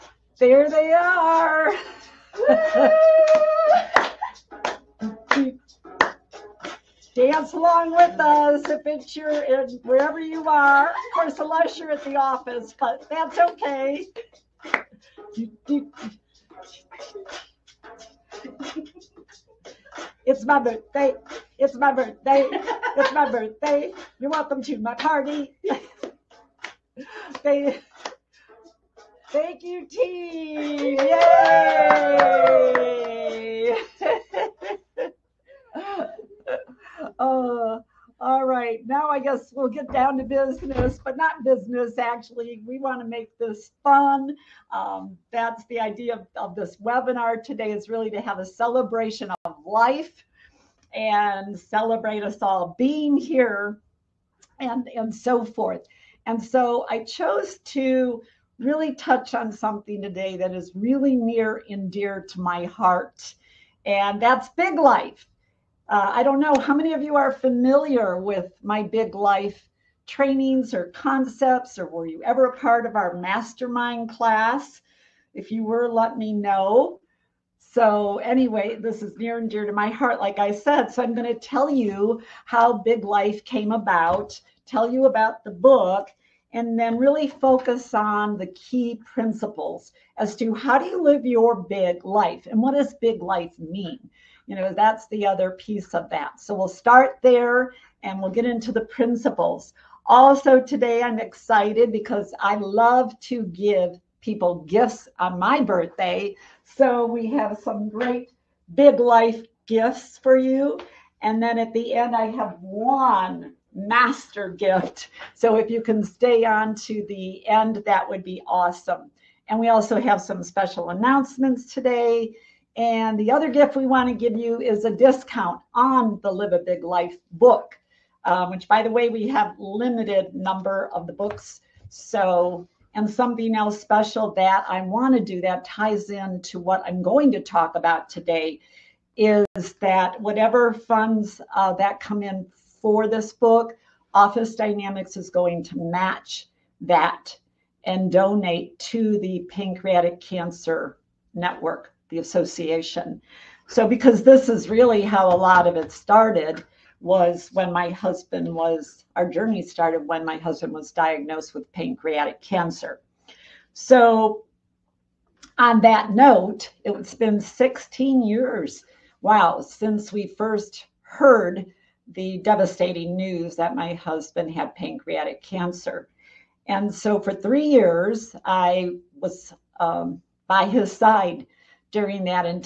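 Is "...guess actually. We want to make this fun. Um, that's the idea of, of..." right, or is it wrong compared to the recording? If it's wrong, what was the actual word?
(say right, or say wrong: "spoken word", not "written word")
wrong: "business", not "guess".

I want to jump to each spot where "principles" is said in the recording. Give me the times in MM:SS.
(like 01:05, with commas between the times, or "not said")
01:29, 01:38.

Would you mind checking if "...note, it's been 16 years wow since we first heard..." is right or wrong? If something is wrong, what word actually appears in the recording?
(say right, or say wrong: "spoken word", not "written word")
right.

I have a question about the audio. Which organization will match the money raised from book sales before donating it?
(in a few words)
Office Dynamics.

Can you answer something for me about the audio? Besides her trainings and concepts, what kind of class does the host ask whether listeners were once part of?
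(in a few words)
mastermind class.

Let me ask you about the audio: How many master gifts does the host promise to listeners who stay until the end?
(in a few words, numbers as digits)
1.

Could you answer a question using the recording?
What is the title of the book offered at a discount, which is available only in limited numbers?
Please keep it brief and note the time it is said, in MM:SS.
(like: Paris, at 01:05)
Live a Big Life, at 02:06.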